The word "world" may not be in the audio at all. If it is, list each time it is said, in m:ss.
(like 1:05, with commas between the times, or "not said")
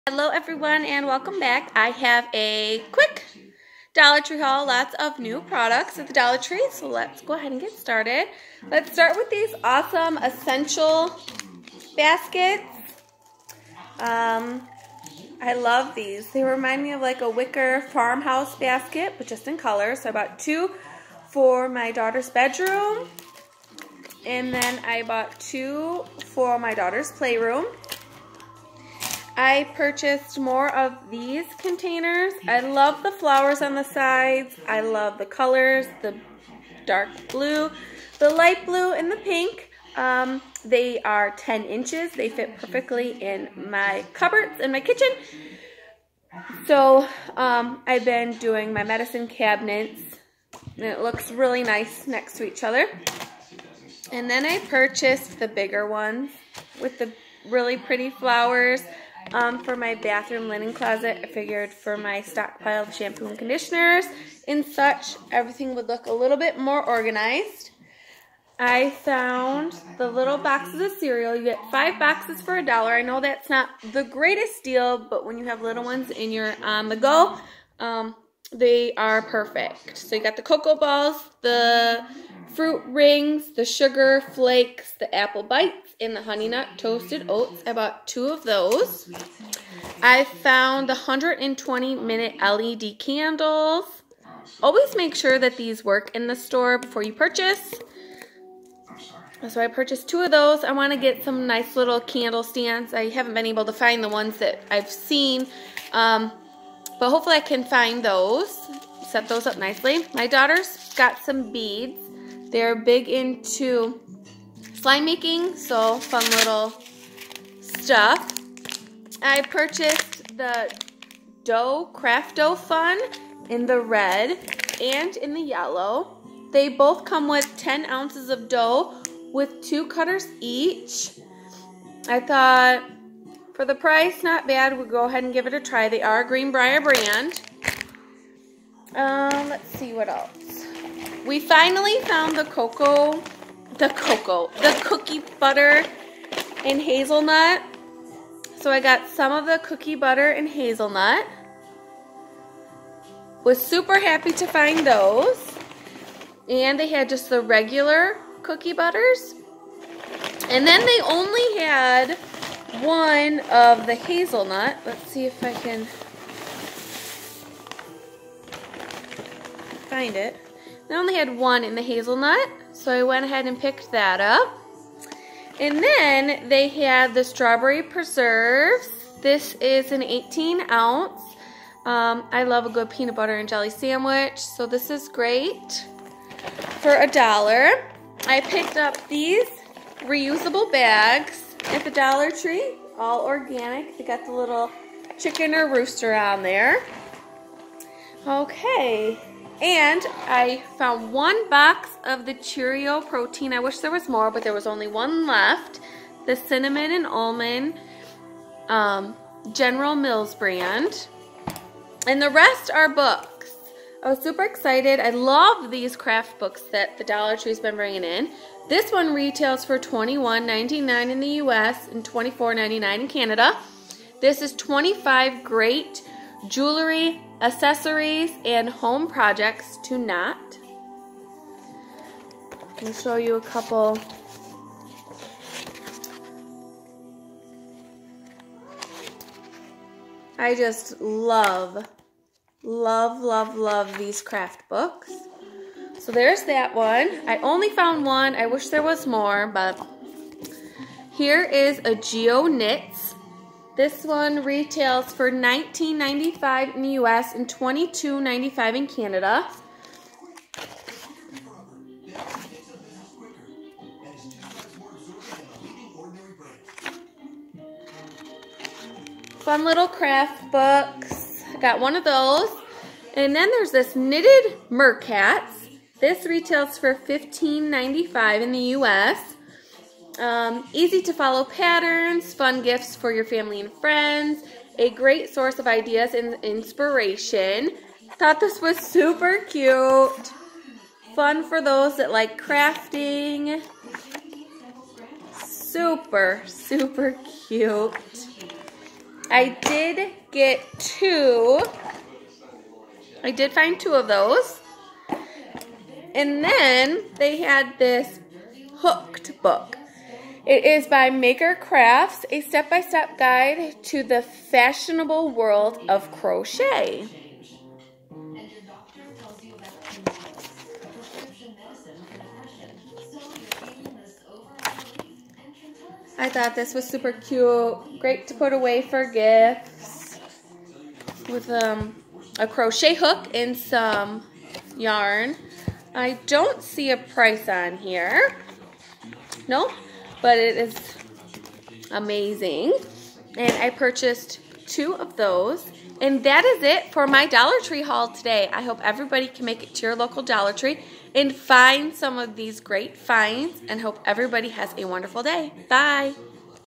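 5:15.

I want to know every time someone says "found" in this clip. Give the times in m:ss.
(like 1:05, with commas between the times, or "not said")
1:08, 1:30, 2:22, 3:20, 4:07.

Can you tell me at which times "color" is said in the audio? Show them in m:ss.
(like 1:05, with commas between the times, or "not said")
0:19, 0:35.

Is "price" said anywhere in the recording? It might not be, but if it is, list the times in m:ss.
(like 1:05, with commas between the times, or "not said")
2:13, 5:36.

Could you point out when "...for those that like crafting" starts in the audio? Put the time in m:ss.
4:51.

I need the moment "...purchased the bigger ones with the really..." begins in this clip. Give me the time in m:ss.
0:54.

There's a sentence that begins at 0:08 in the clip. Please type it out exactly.
Let's start with these awesome essential baskets.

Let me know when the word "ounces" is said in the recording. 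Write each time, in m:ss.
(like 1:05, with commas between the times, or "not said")
2:07, 3:00.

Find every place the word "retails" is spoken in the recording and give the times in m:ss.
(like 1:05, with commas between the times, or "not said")
3:39, 4:14, 4:36.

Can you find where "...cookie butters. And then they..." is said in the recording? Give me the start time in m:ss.
2:38.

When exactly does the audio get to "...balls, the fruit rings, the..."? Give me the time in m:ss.
1:20.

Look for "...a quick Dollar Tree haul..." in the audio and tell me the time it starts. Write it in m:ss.
0:02.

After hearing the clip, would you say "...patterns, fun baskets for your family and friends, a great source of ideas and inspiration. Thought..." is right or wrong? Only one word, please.
wrong.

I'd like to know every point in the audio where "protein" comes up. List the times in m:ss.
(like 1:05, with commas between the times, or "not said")
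3:23.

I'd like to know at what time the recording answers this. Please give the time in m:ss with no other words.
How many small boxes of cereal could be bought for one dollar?
1:11.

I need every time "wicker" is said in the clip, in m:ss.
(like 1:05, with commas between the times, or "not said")
0:17.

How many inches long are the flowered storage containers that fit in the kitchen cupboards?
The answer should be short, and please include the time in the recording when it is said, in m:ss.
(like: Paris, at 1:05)
10 inches, at 0:41.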